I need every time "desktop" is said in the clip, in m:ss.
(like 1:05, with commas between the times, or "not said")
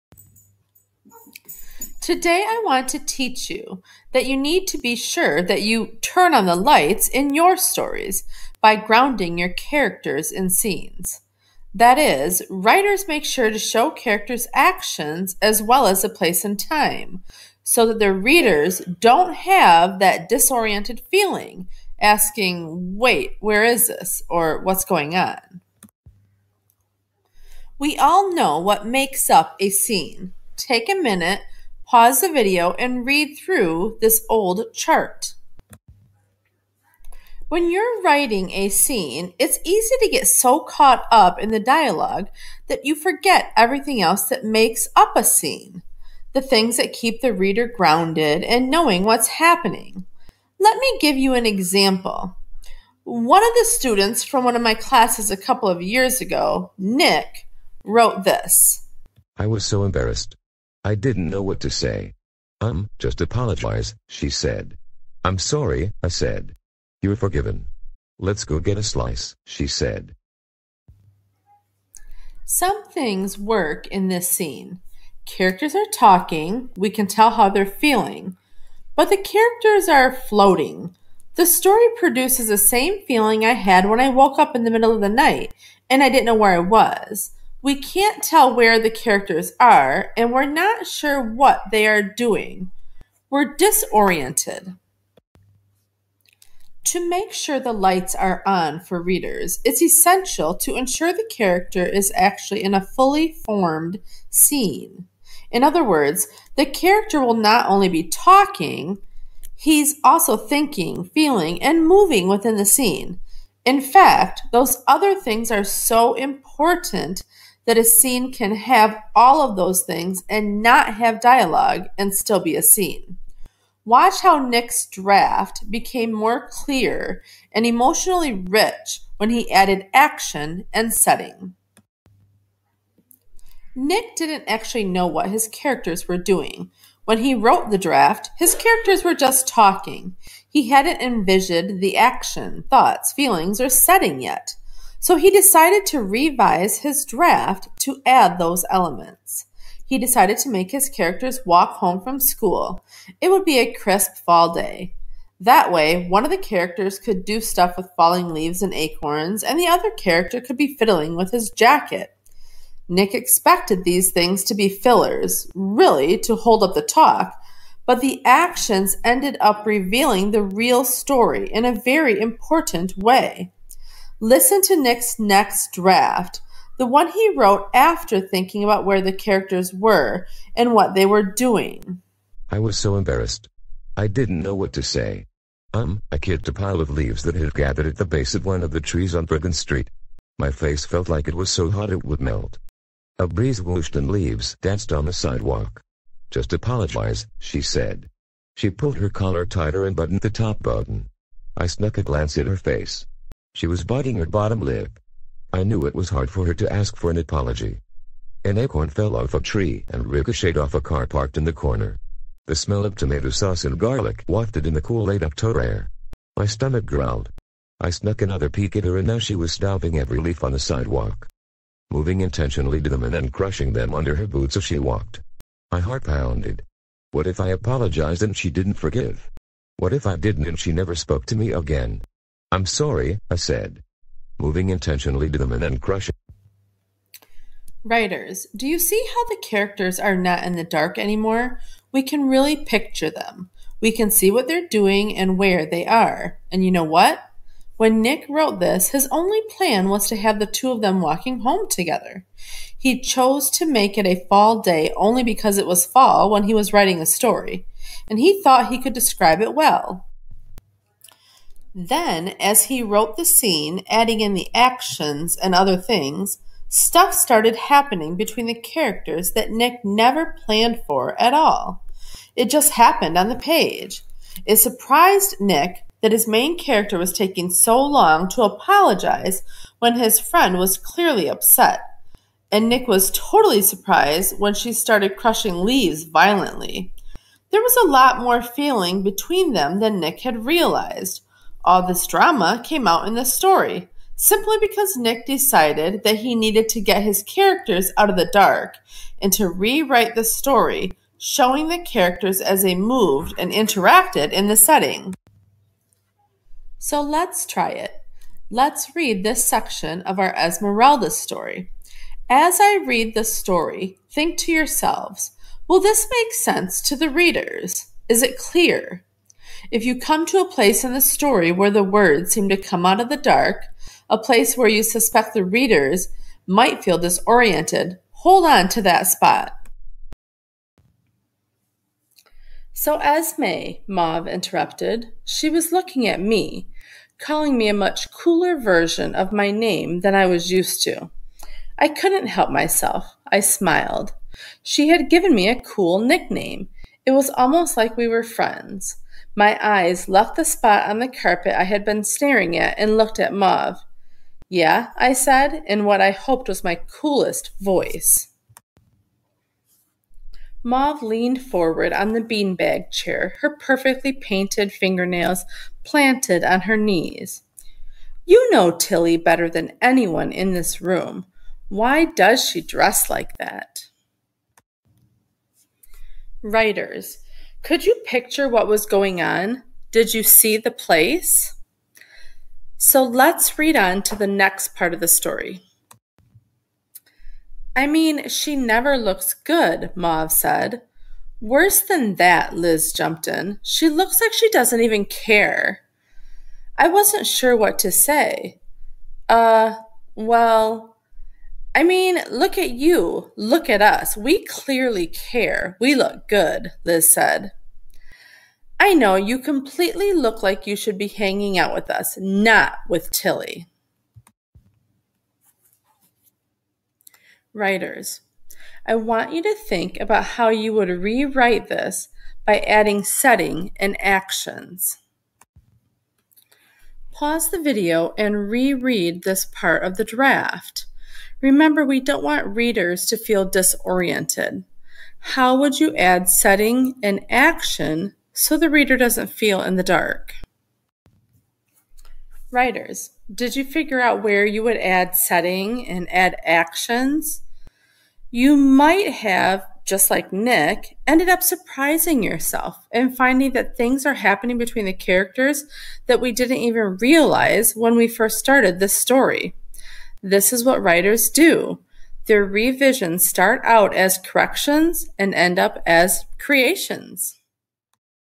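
not said.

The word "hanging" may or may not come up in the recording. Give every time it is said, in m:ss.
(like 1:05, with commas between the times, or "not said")
6:51.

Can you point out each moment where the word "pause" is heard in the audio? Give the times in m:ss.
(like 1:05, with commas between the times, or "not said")
0:31, 7:07.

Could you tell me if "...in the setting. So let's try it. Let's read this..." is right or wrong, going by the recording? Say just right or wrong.
right.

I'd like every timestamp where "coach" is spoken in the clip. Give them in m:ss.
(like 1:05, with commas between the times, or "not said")
not said.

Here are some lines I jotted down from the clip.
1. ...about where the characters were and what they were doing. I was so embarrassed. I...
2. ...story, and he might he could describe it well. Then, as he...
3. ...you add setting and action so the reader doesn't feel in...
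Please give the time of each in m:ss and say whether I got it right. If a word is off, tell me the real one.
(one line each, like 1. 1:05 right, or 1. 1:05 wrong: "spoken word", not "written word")
1. 2:58 right
2. 4:17 wrong: "thought", not "might"
3. 7:15 right.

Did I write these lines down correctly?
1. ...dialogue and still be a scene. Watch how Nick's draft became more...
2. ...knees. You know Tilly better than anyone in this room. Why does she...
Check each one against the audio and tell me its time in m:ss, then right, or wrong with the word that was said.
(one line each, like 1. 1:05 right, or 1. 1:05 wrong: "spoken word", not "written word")
1. 2:01 right
2. 6:06 right.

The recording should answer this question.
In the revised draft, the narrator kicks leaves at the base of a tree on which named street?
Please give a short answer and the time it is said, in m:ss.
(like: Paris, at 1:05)
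Brigham Street, at 3:09.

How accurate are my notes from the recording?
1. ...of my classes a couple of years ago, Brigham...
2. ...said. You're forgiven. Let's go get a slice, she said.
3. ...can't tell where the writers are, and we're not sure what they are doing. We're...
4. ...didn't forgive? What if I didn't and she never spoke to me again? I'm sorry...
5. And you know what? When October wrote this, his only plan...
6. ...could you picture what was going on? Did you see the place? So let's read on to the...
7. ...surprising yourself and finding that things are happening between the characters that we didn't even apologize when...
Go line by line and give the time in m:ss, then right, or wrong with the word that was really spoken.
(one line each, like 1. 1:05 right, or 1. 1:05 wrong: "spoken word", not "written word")
1. 0:54 wrong: "Nick", not "Brigham"
2. 1:06 right
3. 1:27 wrong: "characters", not "writers"
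4. 3:48 right
5. 4:06 wrong: "Nick", not "October"
6. 6:17 right
7. 7:31 wrong: "realize", not "apologize".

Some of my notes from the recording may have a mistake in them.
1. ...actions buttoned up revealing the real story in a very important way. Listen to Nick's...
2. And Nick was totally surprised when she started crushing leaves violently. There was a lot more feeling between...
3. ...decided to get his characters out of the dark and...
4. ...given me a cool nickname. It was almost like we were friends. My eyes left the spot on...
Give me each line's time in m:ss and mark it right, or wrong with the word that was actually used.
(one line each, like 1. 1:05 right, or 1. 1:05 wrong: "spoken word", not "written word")
1. 2:48 wrong: "ended", not "buttoned"
2. 4:42 right
3. 4:56 wrong: "needed", not "decided"
4. 5:45 right.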